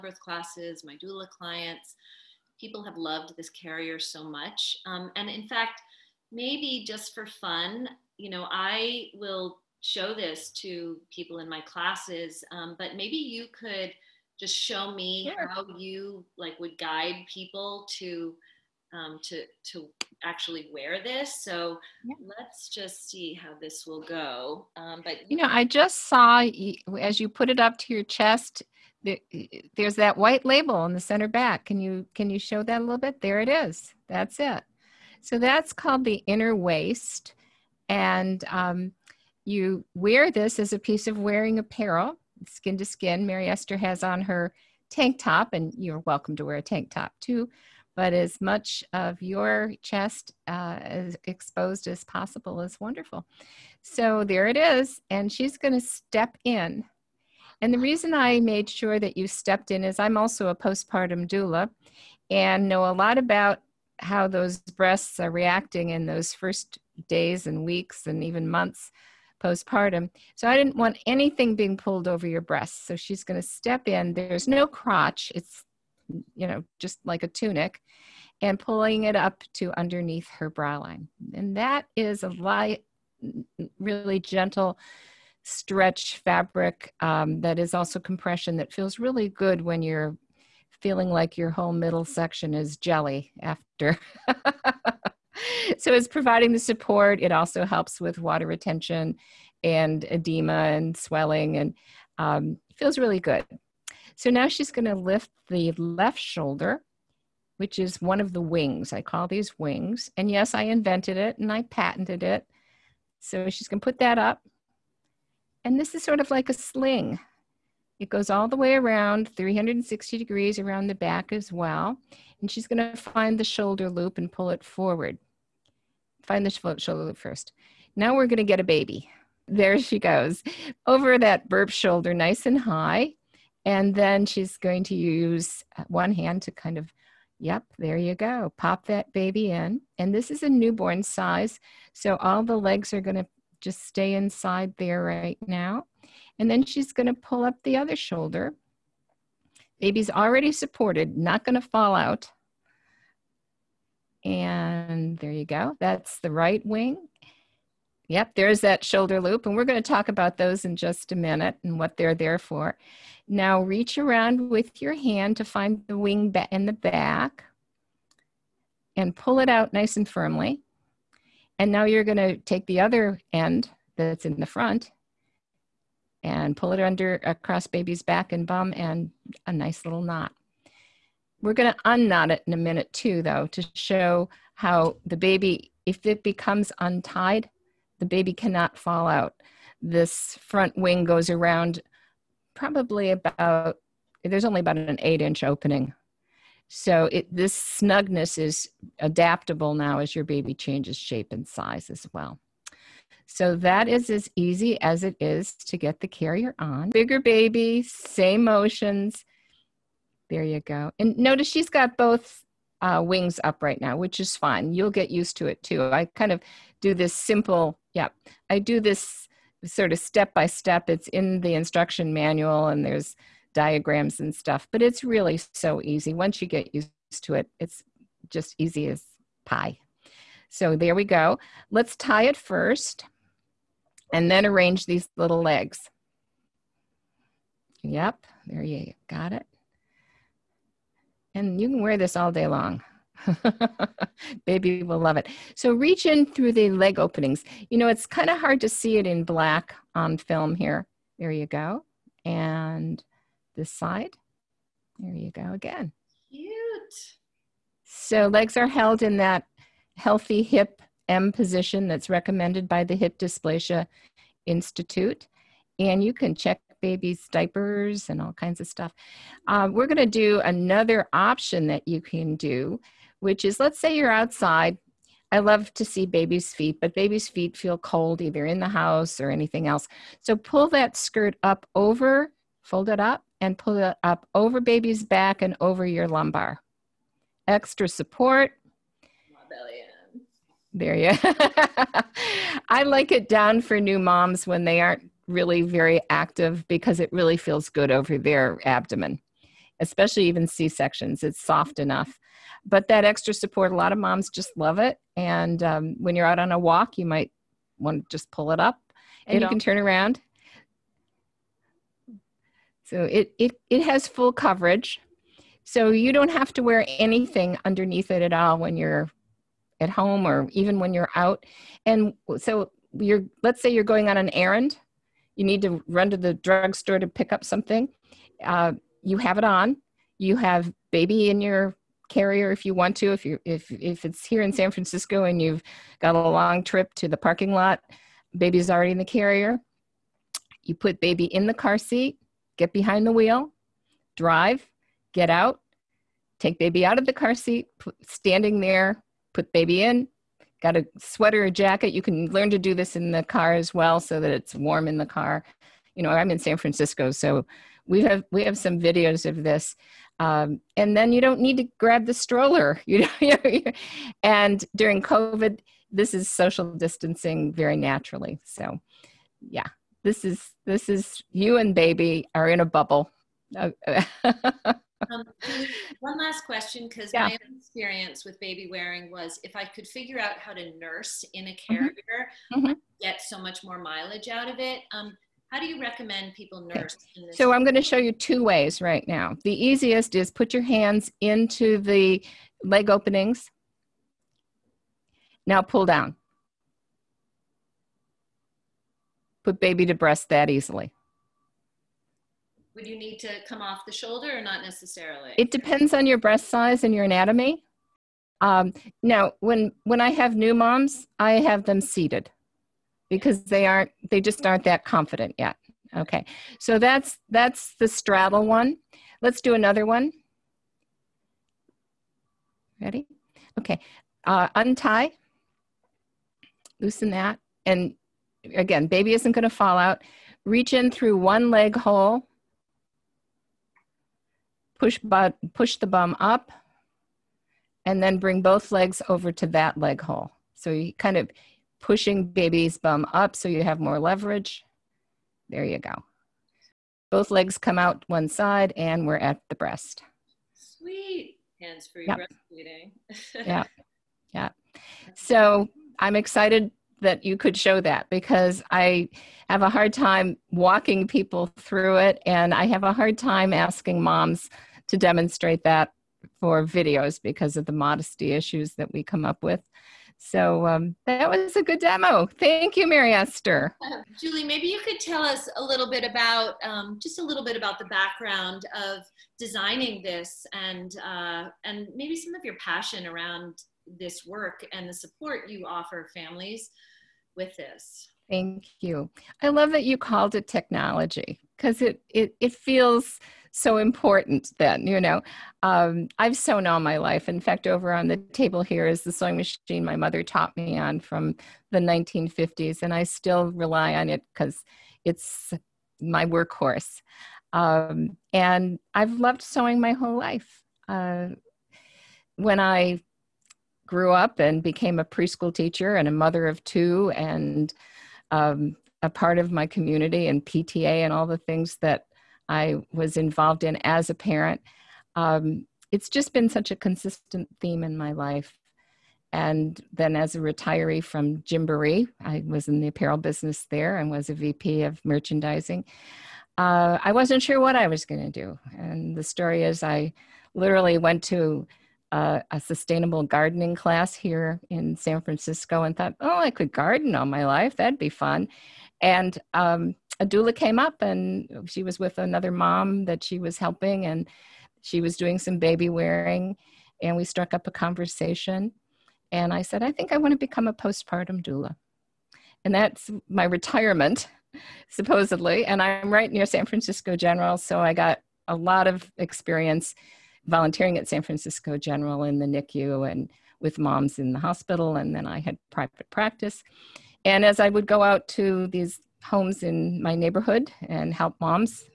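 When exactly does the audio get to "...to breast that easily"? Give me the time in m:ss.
6:39.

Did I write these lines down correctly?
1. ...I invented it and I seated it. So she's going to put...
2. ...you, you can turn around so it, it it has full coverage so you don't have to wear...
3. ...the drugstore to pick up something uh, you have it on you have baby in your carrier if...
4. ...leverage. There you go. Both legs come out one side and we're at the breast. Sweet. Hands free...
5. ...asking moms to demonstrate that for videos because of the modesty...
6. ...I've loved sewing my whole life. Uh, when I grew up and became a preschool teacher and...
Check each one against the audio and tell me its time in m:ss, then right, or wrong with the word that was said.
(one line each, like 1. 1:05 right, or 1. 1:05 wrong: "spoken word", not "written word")
1. 1:50 wrong: "patented", not "seated"
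2. 5:09 right
3. 5:26 right
4. 7:23 right
5. 7:43 right
6. 8:28 right.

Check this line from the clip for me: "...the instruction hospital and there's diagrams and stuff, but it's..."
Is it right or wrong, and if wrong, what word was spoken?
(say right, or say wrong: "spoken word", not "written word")
wrong: "manual", not "hospital".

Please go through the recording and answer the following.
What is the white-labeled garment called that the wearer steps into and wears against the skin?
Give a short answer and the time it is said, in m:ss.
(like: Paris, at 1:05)
inner waist, at 0:36.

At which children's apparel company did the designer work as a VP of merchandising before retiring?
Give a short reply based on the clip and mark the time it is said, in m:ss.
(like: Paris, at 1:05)
Gymboree, at 8:51.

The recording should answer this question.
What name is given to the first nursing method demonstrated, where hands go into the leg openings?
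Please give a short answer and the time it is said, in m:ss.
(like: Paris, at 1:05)
straddle, at 6:57.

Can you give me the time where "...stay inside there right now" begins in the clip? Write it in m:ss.
2:23.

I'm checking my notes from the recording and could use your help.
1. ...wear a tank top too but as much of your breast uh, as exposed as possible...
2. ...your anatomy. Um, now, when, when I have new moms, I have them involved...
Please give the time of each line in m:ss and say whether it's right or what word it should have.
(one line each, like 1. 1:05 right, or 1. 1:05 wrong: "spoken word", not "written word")
1. 0:46 wrong: "chest", not "breast"
2. 6:46 wrong: "seated", not "involved".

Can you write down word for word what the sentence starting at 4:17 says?
So legs are held in that healthy hip M position that's recommended by the Hip Dysplasia Institute.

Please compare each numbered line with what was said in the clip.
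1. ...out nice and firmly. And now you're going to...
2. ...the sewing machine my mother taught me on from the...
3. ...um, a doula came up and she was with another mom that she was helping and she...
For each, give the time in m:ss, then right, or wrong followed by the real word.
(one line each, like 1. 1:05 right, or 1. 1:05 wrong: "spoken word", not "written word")
1. 2:49 right
2. 8:19 right
3. 9:09 right.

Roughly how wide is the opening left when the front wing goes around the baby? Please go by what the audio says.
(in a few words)
8 inches.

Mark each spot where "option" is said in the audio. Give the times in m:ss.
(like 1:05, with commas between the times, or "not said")
4:31.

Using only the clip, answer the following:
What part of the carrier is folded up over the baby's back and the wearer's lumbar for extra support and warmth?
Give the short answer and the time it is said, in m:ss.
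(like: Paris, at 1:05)
skirt, at 4:40.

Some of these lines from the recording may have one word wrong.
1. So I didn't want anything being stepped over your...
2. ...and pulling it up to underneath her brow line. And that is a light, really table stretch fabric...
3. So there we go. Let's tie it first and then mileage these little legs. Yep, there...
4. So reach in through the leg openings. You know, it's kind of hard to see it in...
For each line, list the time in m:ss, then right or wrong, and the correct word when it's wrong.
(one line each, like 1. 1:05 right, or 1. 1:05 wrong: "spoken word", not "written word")
1. 1:10 wrong: "pulled", not "stepped"
2. 1:18 wrong: "gentle", not "table"
3. 3:50 wrong: "arrange", not "mileage"
4. 4:05 right.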